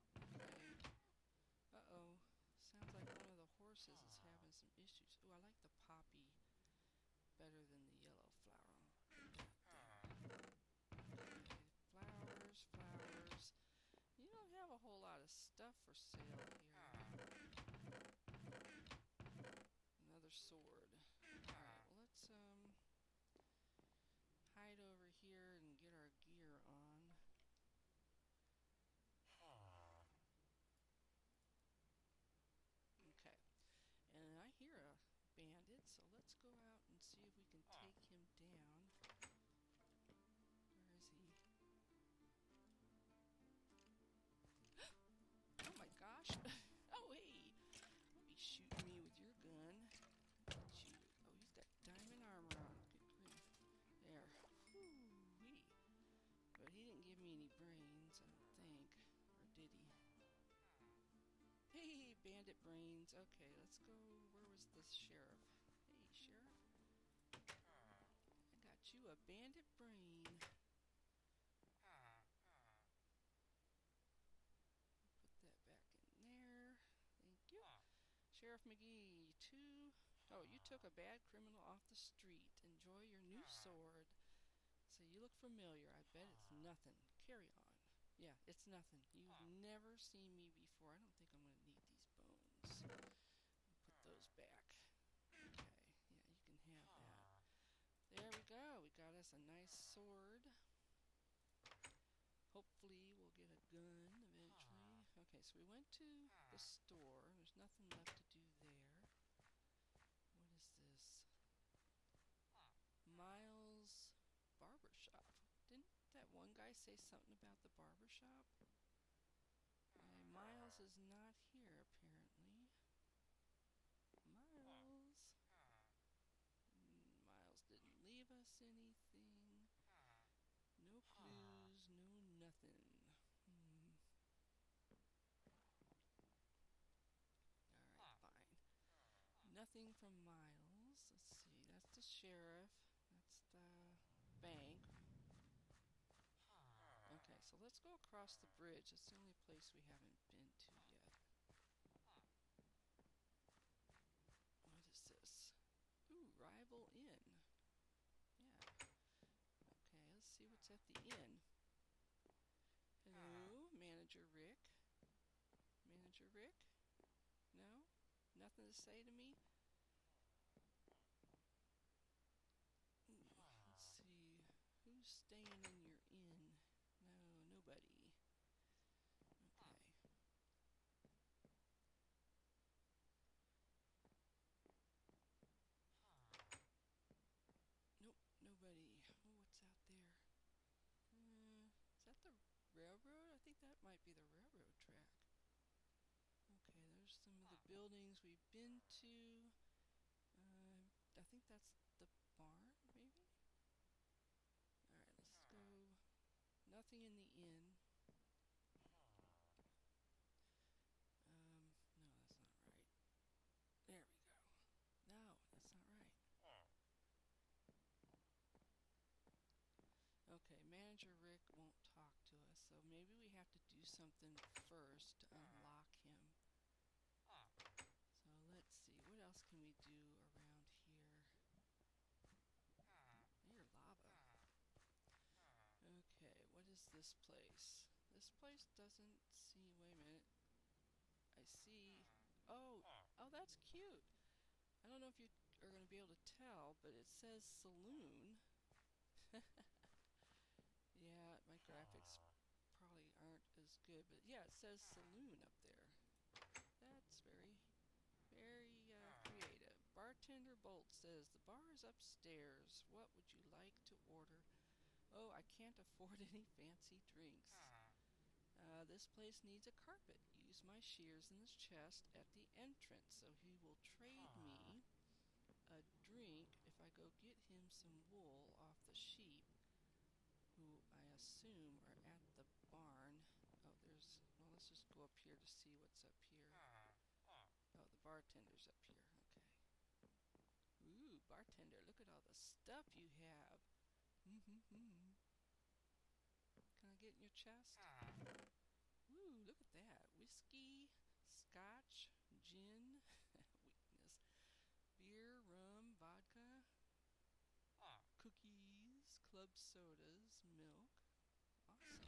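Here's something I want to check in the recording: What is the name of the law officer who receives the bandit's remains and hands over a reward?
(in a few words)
Sheriff McGee.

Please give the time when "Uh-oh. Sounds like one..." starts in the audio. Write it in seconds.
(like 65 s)
1 s.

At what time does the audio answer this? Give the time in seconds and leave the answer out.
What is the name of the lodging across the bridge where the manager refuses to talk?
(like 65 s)
156 s.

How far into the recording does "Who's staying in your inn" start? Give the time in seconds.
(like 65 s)
174 s.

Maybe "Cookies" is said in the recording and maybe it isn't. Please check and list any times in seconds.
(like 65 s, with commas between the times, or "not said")
308 s.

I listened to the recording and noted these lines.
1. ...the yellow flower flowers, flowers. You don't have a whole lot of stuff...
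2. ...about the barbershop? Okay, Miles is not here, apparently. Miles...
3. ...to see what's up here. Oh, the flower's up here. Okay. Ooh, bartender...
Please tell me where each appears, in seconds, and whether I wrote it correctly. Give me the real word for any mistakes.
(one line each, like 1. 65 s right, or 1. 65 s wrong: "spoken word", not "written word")
1. 7 s right
2. 117 s right
3. 285 s wrong: "bartender", not "flower".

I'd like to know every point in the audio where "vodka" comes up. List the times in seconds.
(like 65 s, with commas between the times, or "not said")
305 s.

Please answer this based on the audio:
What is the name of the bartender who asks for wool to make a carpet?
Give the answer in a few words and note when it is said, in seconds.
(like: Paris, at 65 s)
Bartender Bolt, at 259 s.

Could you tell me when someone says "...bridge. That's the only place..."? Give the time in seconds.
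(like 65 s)
148 s.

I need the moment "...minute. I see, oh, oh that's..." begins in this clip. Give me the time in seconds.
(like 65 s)
239 s.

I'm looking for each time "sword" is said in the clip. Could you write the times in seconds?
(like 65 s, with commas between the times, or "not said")
20 s, 83 s, 99 s.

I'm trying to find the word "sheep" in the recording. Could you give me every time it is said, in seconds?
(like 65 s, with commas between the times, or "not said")
278 s.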